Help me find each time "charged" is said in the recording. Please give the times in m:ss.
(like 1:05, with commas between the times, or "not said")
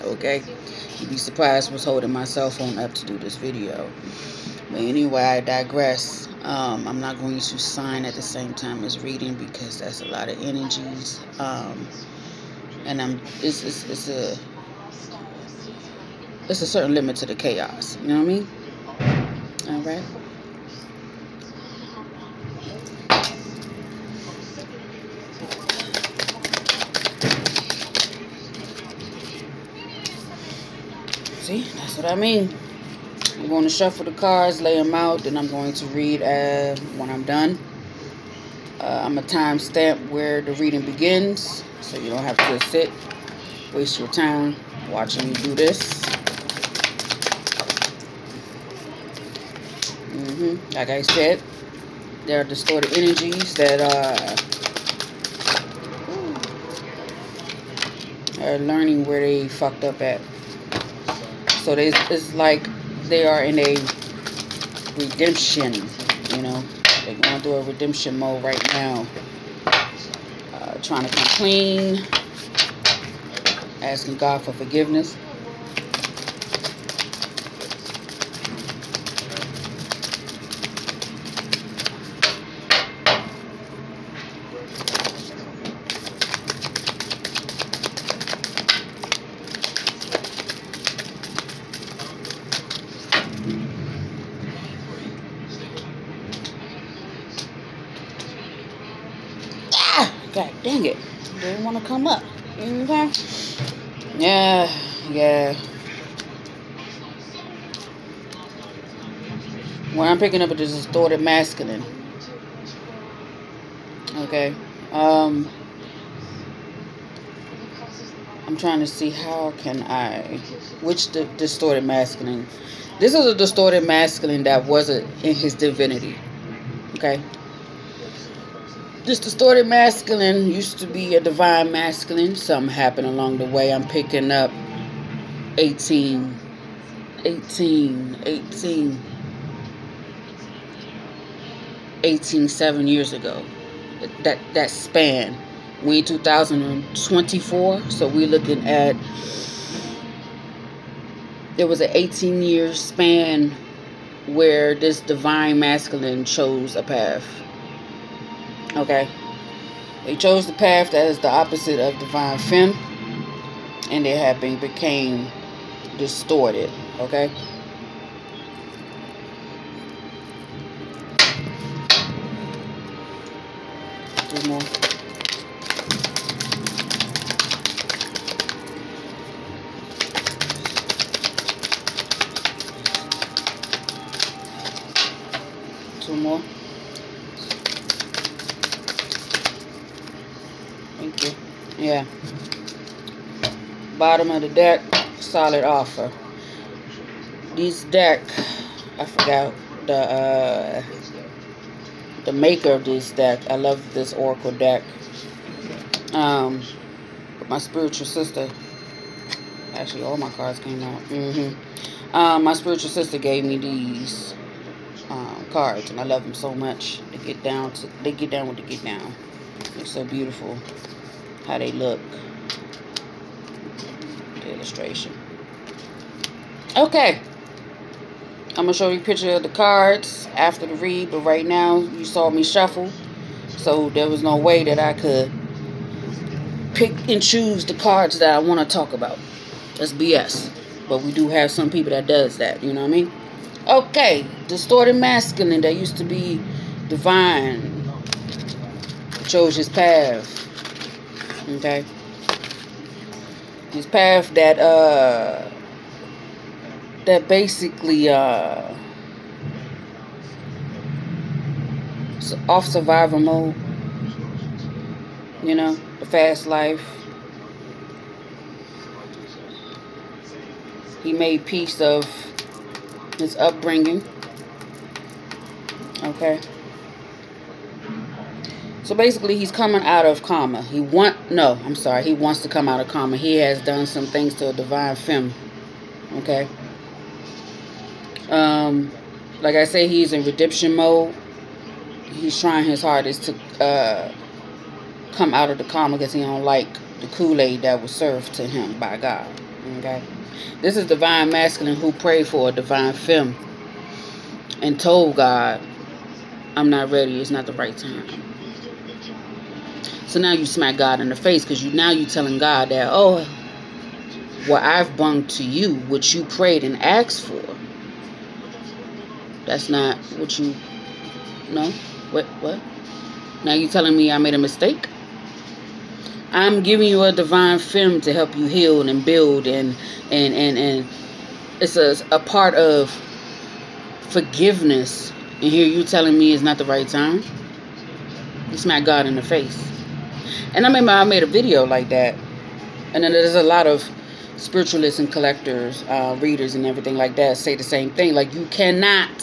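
not said.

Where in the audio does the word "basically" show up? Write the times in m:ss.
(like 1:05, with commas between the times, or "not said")
4:17, 4:38.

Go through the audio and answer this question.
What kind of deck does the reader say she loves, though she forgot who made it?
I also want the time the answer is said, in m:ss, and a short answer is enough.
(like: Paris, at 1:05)
Oracle deck, at 3:24.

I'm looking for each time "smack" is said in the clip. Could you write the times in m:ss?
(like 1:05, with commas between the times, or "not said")
5:10, 5:38.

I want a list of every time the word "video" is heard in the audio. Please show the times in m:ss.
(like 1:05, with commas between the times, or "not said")
0:03, 5:41.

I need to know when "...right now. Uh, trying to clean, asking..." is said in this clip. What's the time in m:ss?
1:08.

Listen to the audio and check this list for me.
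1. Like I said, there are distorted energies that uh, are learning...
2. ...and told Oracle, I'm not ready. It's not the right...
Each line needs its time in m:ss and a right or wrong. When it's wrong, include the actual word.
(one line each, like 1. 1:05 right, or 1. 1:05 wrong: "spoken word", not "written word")
1. 0:50 right
2. 5:04 wrong: "God", not "Oracle".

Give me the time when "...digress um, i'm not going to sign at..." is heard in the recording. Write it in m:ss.
0:05.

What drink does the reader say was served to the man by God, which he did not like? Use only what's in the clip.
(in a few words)
Kool-Aid.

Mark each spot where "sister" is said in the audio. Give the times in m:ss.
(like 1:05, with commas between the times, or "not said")
3:28, 3:32.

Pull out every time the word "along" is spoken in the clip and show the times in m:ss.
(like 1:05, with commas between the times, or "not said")
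2:13.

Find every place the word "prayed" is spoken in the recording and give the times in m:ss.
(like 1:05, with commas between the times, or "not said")
5:01, 5:16.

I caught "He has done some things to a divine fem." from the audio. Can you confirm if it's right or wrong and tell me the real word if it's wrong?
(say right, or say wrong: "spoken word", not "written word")
right.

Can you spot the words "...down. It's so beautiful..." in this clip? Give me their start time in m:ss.
3:38.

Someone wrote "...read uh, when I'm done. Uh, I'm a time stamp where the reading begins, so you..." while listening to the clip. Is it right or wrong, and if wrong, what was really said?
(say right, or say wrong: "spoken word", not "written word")
right.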